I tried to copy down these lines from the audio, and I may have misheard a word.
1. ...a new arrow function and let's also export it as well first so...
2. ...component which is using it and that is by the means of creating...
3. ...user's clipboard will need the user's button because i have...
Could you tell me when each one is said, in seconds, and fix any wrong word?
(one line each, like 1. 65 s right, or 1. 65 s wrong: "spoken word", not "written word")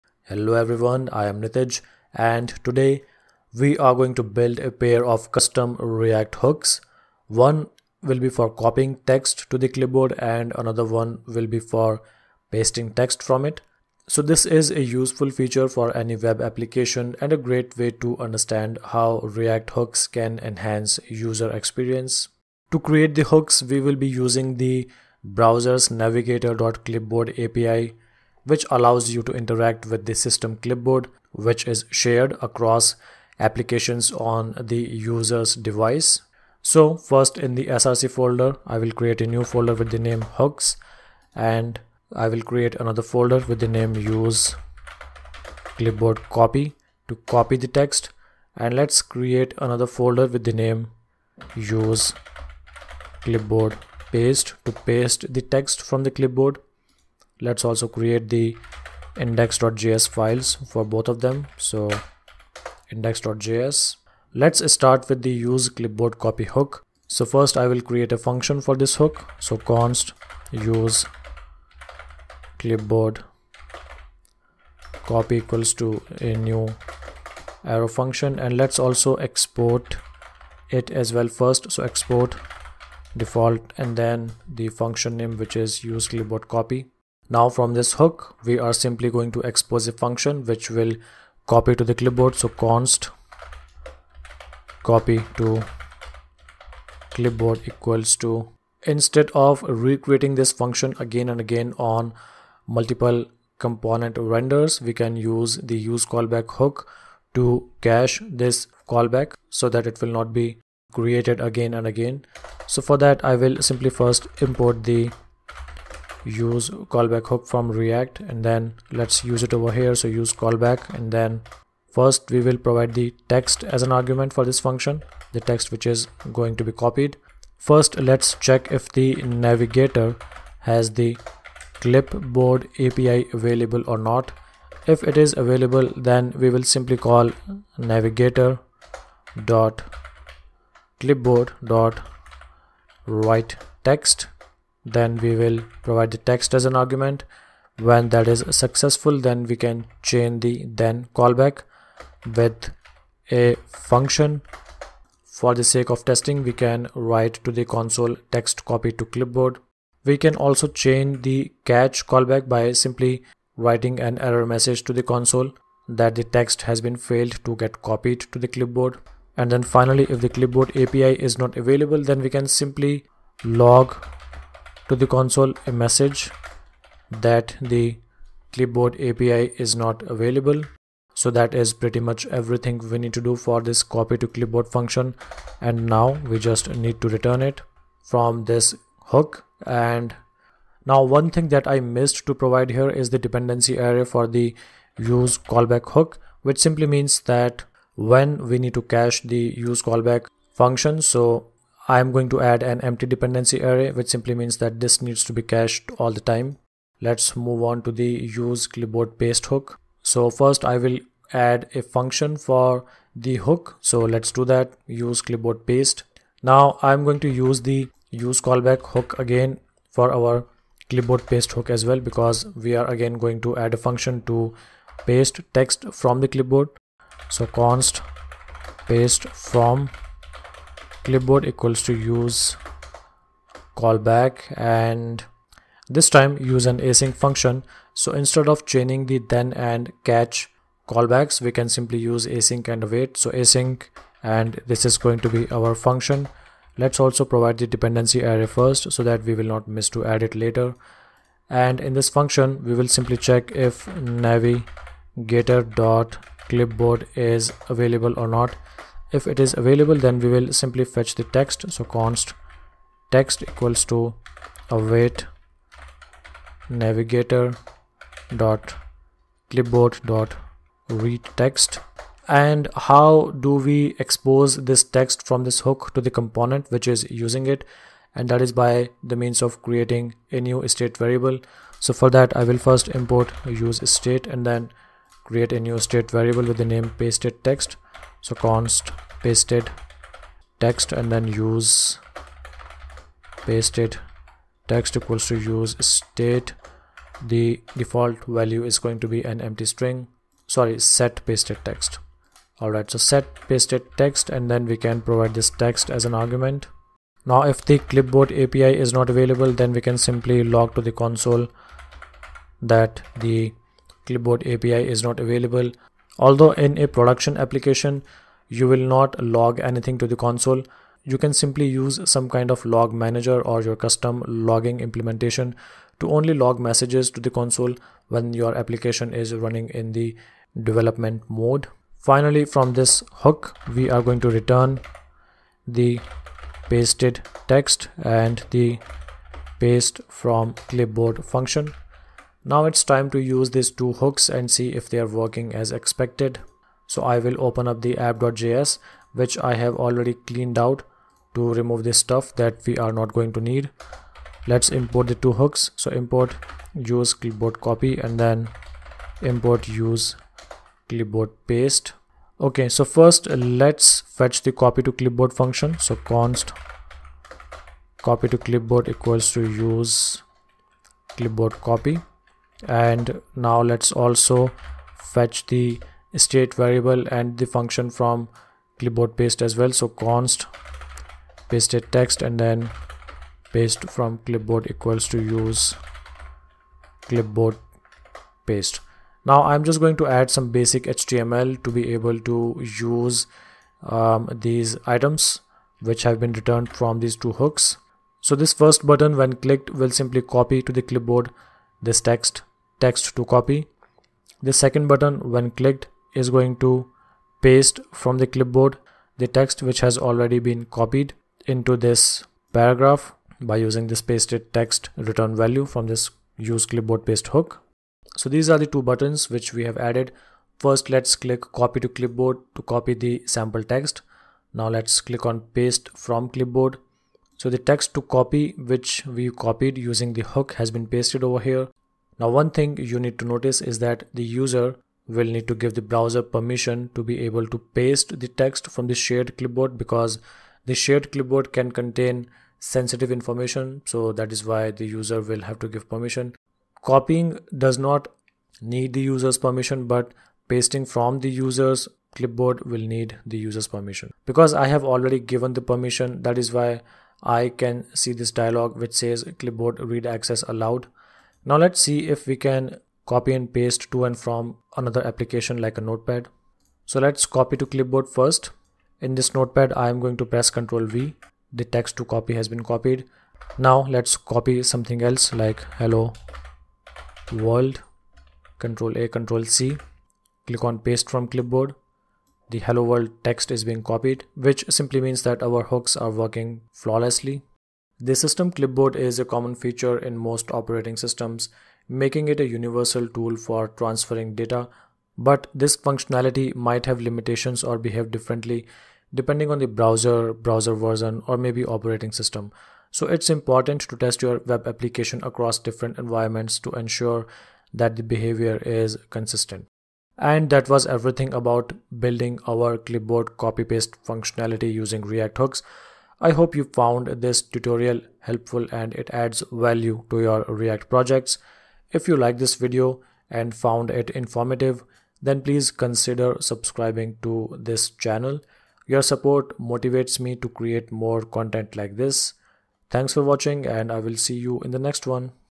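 1. 76 s right
2. 276 s right
3. 451 s wrong: "permission", not "button".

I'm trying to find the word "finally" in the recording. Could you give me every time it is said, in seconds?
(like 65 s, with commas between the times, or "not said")
169 s, 331 s.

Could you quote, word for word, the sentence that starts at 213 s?
So let's do that use clipboard paste.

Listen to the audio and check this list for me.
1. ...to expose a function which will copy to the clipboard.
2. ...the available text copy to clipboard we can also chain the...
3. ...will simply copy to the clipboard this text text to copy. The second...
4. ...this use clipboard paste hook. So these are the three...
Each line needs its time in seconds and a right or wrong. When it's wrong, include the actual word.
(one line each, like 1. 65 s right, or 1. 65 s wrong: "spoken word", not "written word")
1. 89 s right
2. 157 s wrong: "console", not "available"
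3. 399 s right
4. 415 s wrong: "two", not "three".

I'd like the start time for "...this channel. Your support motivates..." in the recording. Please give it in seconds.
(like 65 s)
527 s.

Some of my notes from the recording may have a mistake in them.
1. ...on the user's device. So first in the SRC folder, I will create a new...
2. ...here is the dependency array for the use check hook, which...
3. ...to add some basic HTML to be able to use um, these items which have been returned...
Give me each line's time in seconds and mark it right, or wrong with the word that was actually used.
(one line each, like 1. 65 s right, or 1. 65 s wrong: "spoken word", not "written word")
1. 34 s right
2. 192 s wrong: "callback", not "check"
3. 389 s right.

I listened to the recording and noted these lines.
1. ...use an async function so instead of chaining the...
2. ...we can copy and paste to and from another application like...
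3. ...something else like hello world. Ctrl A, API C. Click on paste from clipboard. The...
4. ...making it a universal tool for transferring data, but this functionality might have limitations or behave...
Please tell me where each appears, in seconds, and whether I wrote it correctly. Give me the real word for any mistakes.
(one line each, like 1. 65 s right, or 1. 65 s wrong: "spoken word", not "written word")
1. 236 s right
2. 462 s right
3. 474 s wrong: "Ctrl", not "API"
4. 491 s right.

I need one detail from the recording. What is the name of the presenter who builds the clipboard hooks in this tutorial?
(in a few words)
Nitij.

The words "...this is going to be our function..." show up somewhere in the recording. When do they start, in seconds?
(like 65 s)
244 s.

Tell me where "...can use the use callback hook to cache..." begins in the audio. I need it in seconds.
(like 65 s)
104 s.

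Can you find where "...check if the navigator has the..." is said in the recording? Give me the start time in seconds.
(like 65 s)
128 s.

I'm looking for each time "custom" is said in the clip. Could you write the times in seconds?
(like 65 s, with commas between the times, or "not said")
5 s, 323 s.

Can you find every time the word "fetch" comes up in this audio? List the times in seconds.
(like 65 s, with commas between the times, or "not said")
260 s, 364 s, 374 s.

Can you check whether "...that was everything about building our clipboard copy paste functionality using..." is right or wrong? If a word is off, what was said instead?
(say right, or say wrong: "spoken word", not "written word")
right.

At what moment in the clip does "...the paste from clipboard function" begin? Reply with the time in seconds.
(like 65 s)
338 s.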